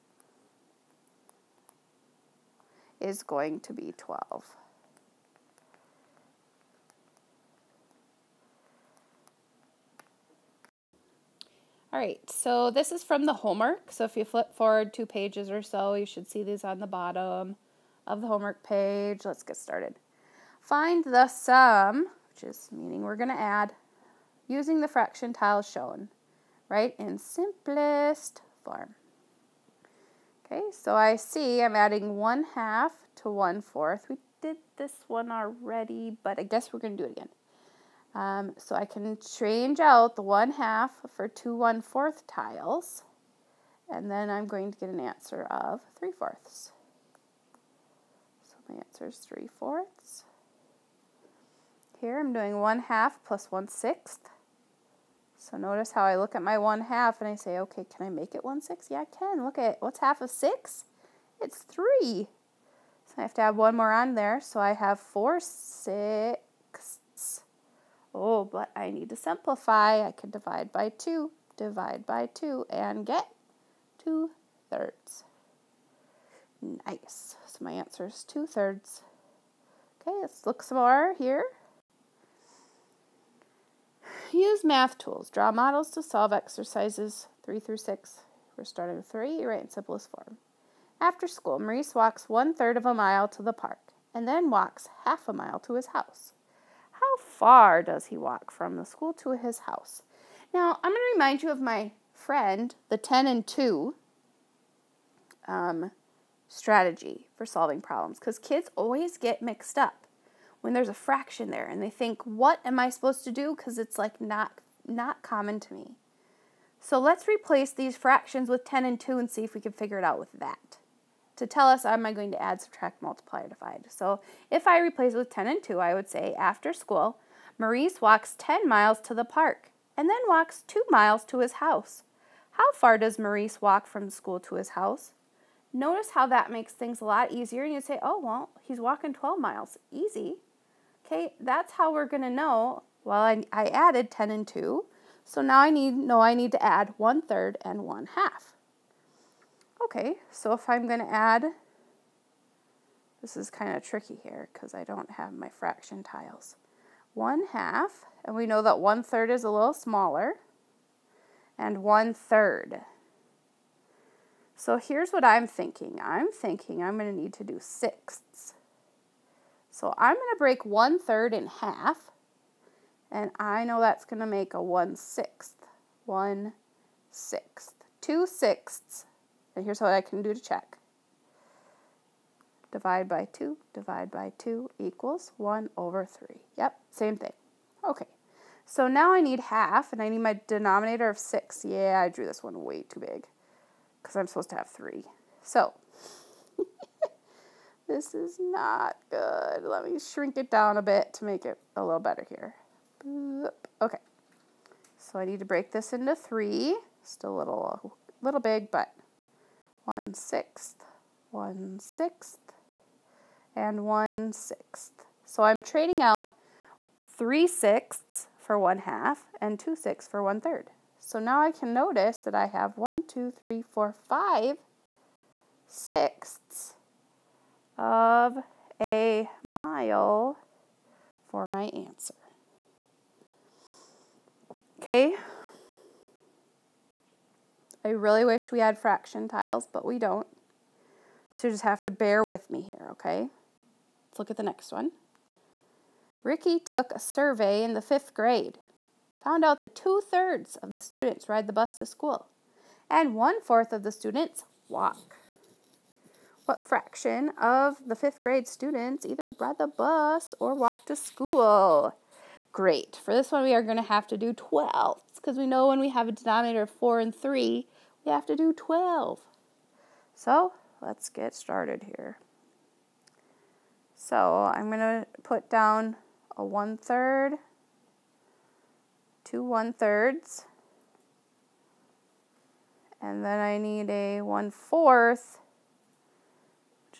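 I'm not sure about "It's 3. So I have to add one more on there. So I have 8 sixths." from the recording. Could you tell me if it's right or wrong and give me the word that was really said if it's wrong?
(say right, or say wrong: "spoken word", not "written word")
wrong: "4", not "8".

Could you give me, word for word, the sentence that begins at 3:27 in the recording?
Still a little, little big, but one sixth, one sixth, and one sixth.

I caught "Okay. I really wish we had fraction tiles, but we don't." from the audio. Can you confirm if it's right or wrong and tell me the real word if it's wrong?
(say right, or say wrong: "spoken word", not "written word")
right.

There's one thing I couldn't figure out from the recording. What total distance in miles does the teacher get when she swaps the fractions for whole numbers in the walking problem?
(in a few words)
12 miles.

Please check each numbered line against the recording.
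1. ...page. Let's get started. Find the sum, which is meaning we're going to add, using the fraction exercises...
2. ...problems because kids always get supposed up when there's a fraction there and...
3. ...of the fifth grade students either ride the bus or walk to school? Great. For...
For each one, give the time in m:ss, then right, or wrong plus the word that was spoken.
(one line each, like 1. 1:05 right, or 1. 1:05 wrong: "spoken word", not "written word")
1. 0:18 wrong: "tiles", not "exercises"
2. 1:47 wrong: "mixed", not "supposed"
3. 4:17 right.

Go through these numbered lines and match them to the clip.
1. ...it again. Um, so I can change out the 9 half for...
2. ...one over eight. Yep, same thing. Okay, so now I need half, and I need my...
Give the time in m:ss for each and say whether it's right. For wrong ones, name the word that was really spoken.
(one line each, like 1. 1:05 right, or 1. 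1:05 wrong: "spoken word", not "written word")
1. 0:37 wrong: "1", not "9"
2. 3:05 wrong: "three", not "eight".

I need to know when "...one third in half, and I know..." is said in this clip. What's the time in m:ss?
2:50.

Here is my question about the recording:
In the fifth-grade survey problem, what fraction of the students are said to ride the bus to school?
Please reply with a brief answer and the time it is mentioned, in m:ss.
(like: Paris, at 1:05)
2/3, at 4:09.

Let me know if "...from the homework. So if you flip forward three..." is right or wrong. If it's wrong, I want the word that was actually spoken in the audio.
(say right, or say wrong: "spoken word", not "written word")
wrong: "two", not "three".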